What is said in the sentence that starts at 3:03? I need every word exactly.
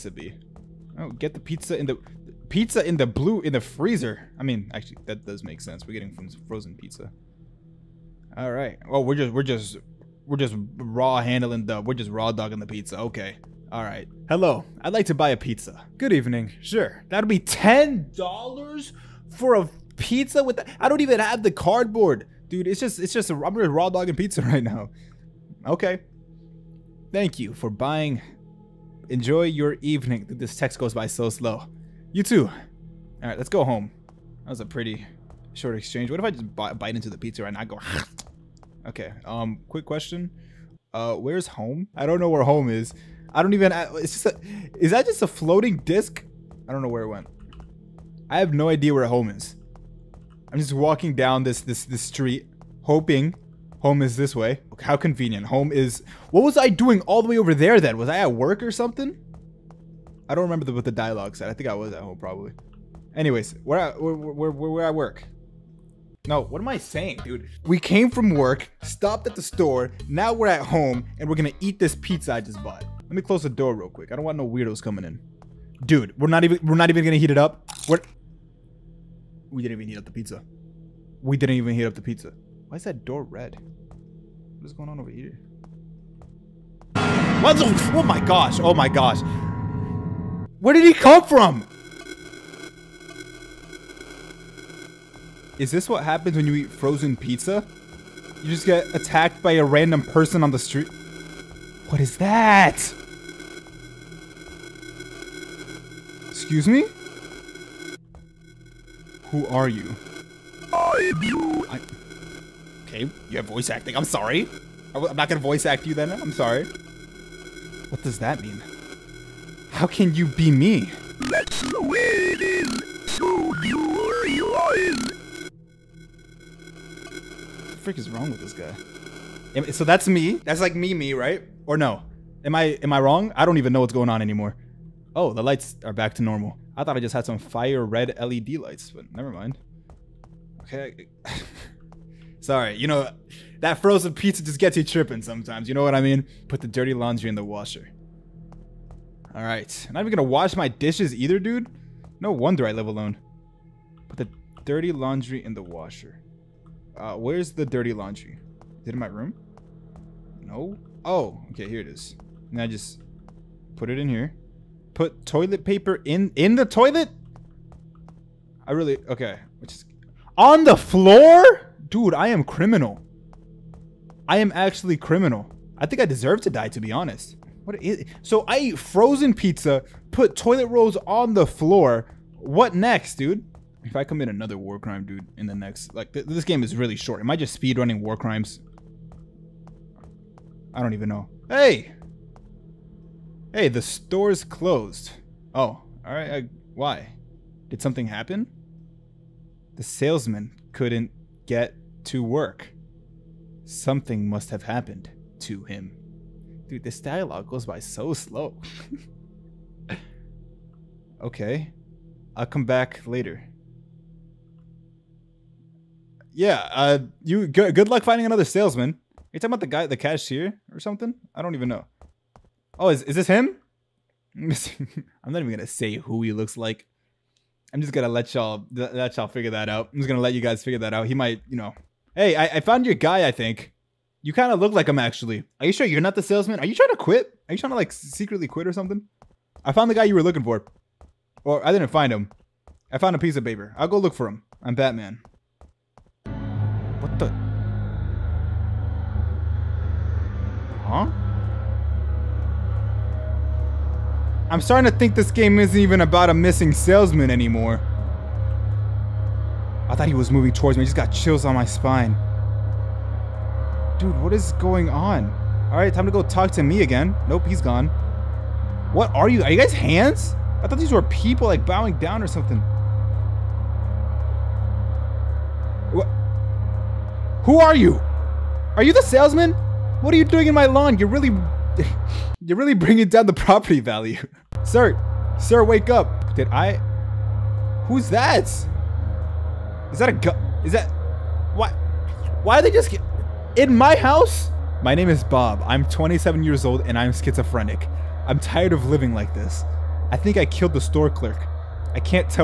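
If I commit another war crime, dude, in the next...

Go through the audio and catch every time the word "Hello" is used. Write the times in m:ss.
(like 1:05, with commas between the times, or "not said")
0:14.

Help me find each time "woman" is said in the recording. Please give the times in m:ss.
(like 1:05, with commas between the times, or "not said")
not said.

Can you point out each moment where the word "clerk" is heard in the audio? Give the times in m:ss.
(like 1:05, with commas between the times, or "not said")
5:01.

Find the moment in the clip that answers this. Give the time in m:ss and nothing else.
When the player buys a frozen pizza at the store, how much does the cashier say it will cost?
0:17.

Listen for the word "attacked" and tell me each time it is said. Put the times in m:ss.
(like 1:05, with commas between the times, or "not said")
1:38.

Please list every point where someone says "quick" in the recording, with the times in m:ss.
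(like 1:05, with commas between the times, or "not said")
0:39, 1:13.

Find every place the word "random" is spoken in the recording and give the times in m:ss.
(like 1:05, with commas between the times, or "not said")
1:39.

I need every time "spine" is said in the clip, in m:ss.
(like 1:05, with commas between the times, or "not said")
4:21.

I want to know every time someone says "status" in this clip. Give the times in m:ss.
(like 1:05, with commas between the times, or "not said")
not said.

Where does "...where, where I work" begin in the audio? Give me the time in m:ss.
1:04.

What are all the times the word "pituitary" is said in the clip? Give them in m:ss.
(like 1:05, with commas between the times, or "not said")
not said.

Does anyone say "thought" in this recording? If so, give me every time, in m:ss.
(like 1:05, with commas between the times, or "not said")
2:16, 4:19, 4:30.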